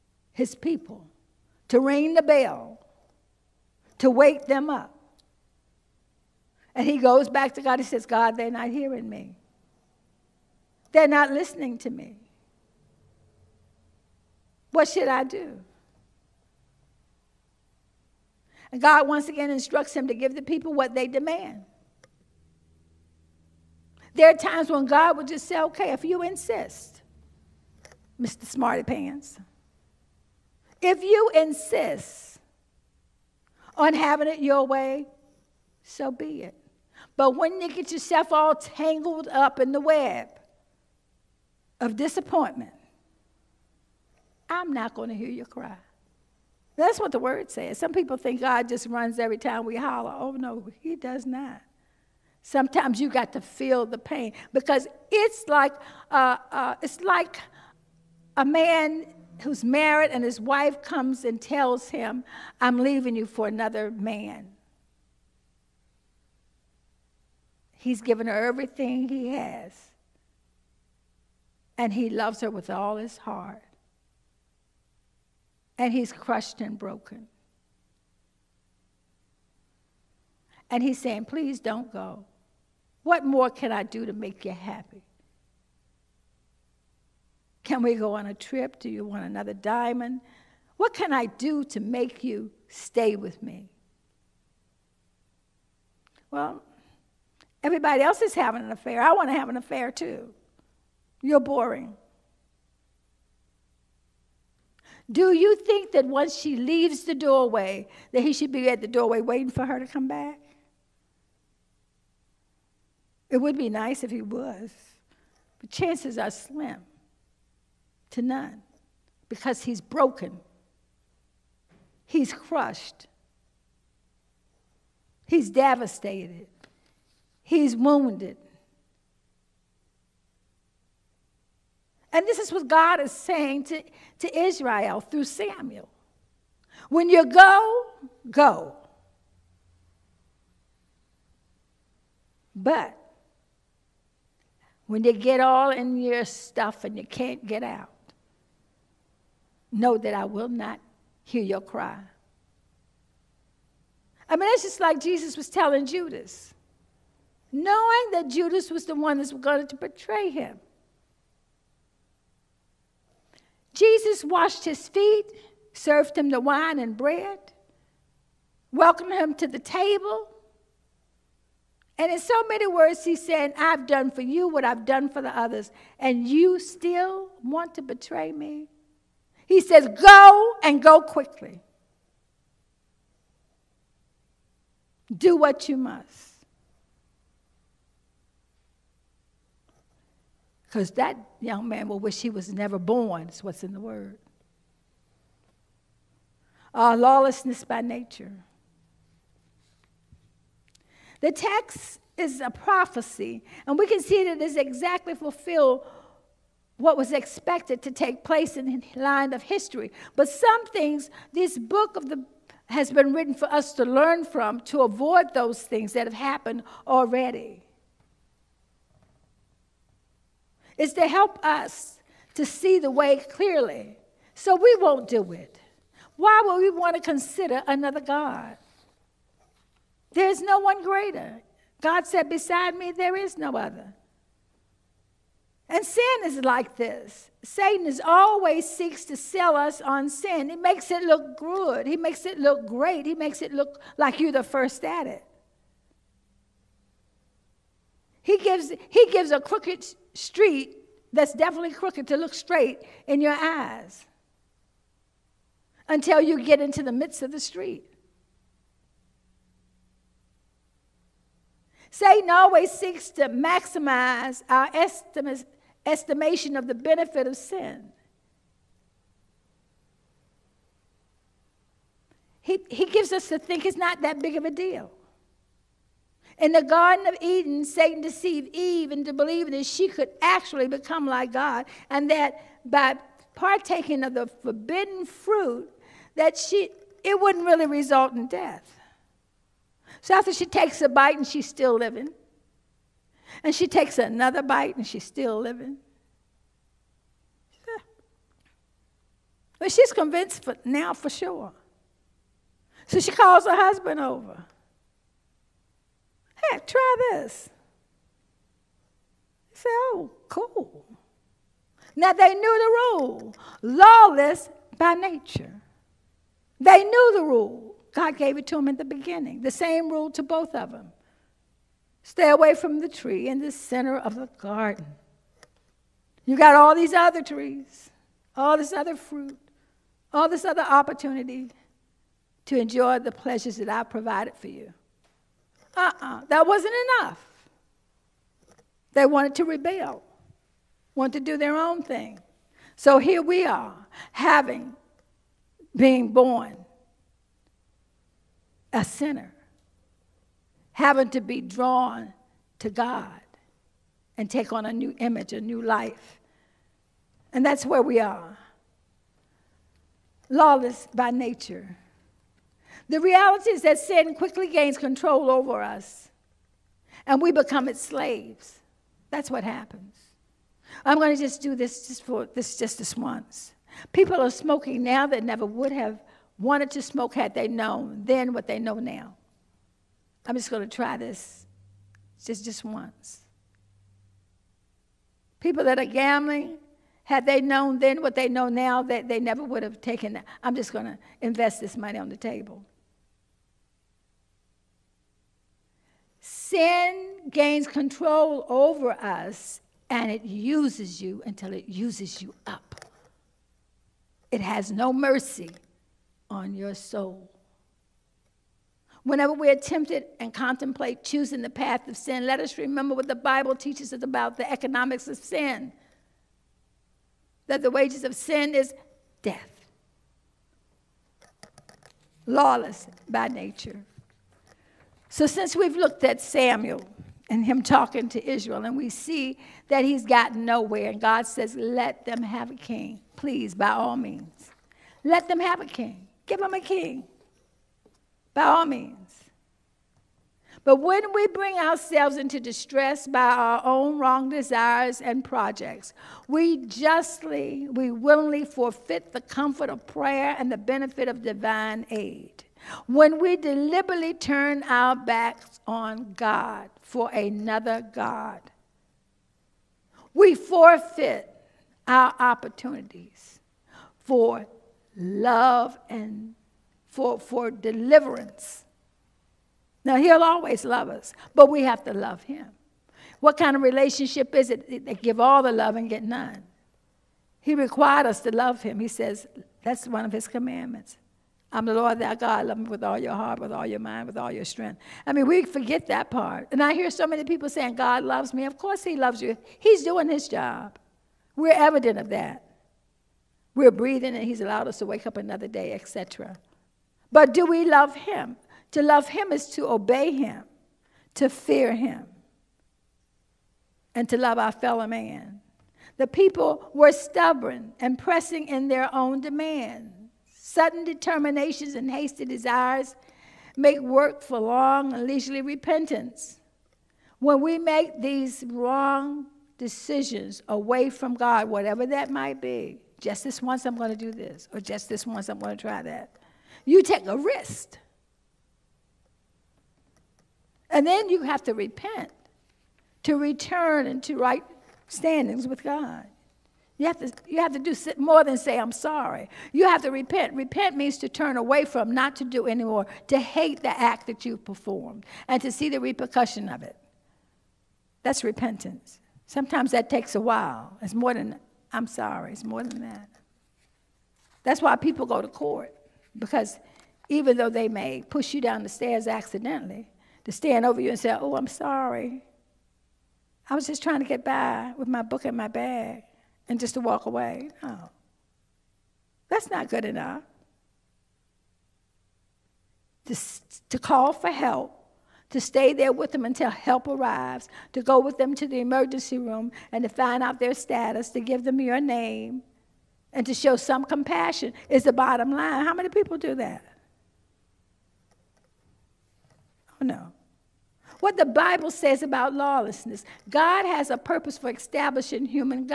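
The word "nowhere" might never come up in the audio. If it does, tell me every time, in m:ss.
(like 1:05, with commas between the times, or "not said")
7:10.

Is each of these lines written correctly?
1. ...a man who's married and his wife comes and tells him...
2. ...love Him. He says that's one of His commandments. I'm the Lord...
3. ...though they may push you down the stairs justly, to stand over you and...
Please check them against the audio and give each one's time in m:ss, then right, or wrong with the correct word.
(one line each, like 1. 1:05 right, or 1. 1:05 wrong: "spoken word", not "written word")
1. 0:58 right
2. 7:58 right
3. 9:17 wrong: "accidentally", not "justly".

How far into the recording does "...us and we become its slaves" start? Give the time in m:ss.
6:05.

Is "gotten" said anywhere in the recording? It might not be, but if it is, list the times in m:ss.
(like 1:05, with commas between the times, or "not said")
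7:10.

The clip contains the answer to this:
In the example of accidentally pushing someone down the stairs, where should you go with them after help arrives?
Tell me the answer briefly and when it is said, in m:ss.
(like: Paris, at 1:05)
Emergency room, at 9:38.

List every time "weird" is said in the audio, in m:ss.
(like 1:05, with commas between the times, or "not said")
not said.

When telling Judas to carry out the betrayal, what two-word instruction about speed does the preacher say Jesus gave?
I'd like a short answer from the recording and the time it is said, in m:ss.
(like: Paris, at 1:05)
Go quickly, at 3:00.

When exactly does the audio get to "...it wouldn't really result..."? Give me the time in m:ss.
4:47.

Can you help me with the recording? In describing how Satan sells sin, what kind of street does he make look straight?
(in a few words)
Crooked street.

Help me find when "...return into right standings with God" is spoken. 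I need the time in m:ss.
8:53.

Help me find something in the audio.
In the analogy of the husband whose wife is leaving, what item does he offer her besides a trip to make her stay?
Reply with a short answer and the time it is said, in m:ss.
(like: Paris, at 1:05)
Another diamond, at 1:29.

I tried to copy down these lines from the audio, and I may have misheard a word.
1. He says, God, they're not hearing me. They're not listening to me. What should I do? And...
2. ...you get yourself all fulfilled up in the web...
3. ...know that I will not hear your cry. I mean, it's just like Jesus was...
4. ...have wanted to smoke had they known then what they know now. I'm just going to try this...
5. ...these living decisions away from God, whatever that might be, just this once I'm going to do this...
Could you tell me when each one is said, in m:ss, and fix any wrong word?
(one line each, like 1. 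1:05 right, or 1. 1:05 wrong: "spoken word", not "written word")
1. 0:07 right
2. 0:37 wrong: "tangled", not "fulfilled"
3. 2:29 right
4. 6:15 right
5. 8:38 wrong: "wrong", not "living".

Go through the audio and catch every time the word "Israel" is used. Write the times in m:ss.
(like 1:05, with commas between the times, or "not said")
2:14, 7:08.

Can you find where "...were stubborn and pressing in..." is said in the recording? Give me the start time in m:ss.
8:26.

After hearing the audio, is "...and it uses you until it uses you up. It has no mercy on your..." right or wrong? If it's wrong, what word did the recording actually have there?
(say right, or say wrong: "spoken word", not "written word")
right.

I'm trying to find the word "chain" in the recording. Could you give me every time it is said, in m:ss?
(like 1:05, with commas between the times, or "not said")
not said.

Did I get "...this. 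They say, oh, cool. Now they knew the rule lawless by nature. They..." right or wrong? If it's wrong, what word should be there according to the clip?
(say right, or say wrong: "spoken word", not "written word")
right.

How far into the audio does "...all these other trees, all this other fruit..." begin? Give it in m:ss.
5:26.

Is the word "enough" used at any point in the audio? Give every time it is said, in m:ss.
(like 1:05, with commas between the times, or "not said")
5:36, 9:29.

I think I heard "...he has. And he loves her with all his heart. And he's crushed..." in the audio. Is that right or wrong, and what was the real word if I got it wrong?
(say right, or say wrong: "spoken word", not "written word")
right.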